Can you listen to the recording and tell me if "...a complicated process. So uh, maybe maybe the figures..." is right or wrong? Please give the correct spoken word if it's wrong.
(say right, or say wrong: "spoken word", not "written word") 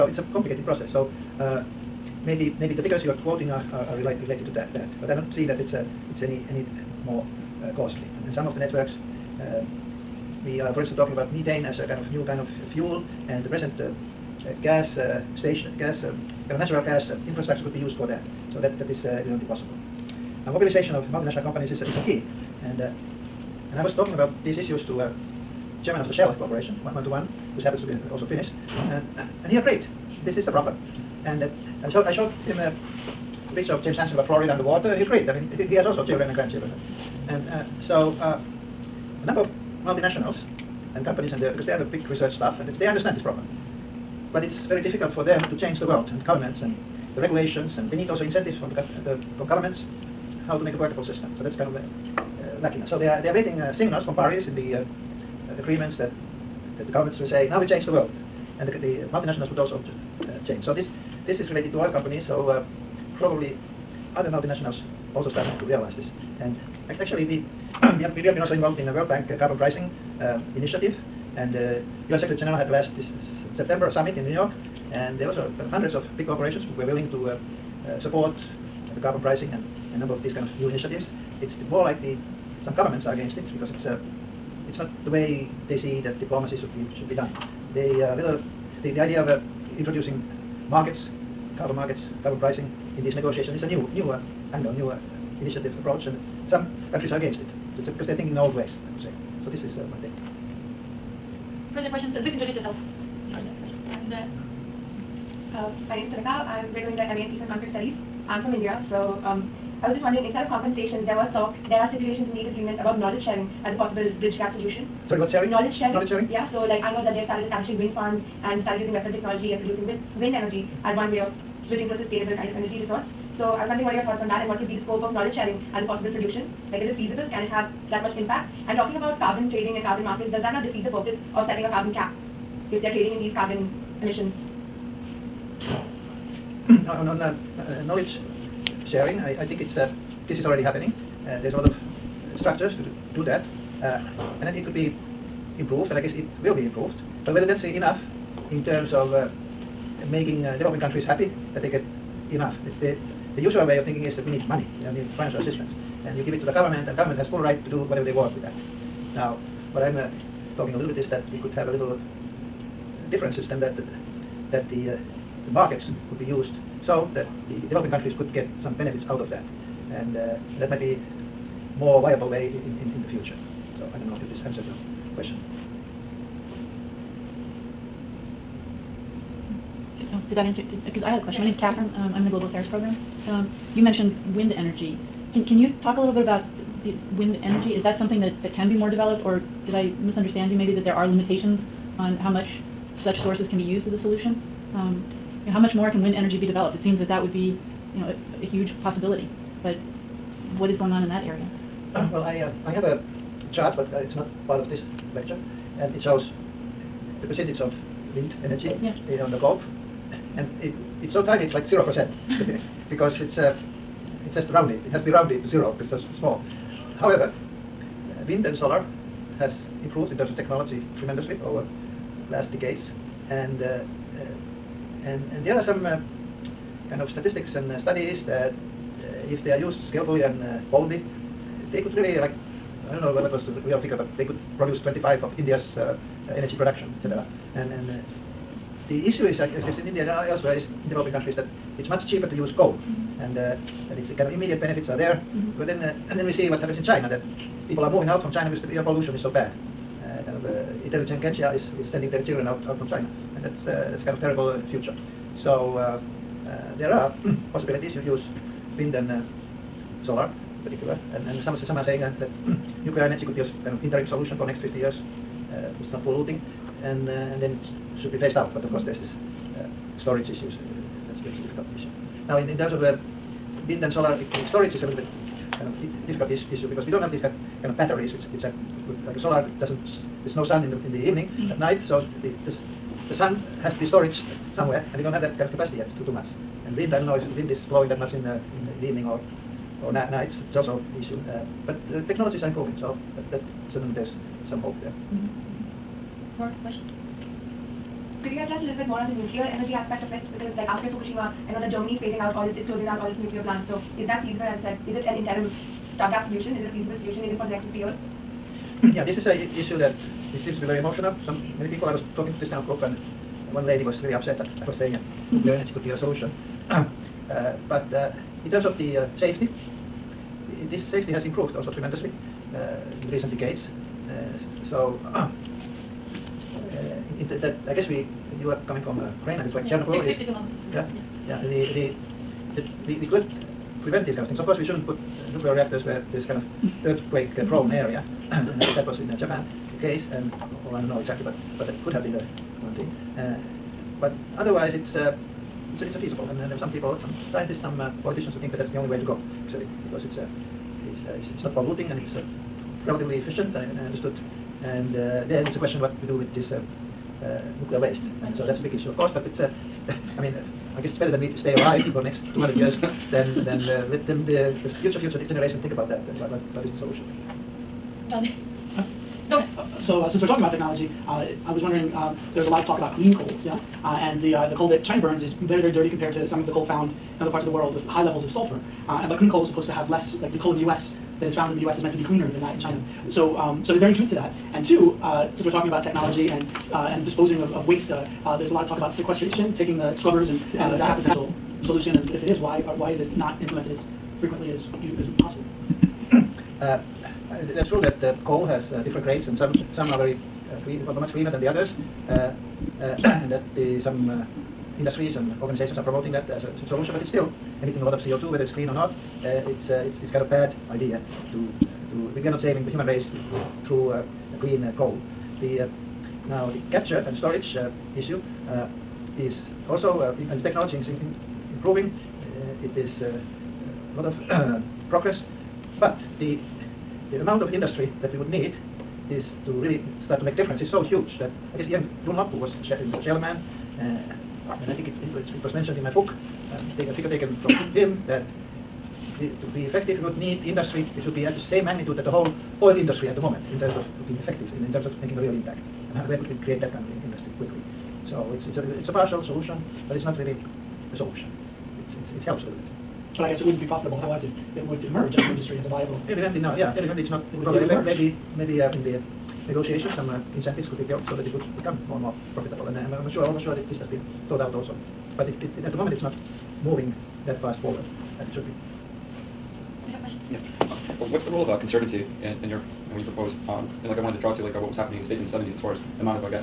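right.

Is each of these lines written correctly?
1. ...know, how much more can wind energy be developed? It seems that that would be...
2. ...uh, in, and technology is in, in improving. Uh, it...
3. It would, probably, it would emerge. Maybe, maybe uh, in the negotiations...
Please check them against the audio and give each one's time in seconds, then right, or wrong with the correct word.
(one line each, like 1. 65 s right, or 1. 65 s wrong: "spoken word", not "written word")
1. 195 s right
2. 420 s right
3. 457 s right.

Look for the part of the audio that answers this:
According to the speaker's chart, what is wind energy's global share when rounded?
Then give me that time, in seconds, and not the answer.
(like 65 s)
211 s.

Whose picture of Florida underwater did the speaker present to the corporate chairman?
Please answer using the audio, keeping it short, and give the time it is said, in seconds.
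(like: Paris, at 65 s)
James Hansen, at 33 s.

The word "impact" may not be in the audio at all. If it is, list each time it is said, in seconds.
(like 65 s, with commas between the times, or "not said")
128 s, 445 s.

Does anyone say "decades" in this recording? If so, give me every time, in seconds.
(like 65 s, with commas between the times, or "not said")
222 s, 323 s.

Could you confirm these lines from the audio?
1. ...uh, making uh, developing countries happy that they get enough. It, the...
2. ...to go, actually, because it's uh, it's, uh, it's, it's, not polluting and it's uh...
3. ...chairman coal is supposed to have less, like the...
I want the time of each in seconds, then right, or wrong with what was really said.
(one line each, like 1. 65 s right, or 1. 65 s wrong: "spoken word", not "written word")
1. 149 s right
2. 348 s right
3. 379 s wrong: "clean", not "chairman".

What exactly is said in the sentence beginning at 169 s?
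And uh, that might be more viable way in, in, in the future.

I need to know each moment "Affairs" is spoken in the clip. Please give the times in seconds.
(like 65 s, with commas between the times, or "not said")
182 s.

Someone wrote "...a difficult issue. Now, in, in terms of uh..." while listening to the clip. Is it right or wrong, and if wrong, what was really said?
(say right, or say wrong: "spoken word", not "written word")
right.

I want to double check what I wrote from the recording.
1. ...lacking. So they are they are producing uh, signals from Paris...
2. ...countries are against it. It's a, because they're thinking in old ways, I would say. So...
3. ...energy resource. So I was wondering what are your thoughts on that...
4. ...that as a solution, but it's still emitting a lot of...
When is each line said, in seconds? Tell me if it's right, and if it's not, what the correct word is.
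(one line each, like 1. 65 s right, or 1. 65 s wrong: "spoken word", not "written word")
1. 52 s wrong: "waiting", not "producing"
2. 96 s right
3. 122 s right
4. 406 s right.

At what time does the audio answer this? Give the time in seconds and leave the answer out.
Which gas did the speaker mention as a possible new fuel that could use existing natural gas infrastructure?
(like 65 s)
11 s.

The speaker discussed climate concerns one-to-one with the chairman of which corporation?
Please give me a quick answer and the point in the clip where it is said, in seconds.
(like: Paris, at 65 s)
Shell, at 26 s.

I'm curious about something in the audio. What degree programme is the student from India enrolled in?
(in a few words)
MA in Peace and Conflict Studies.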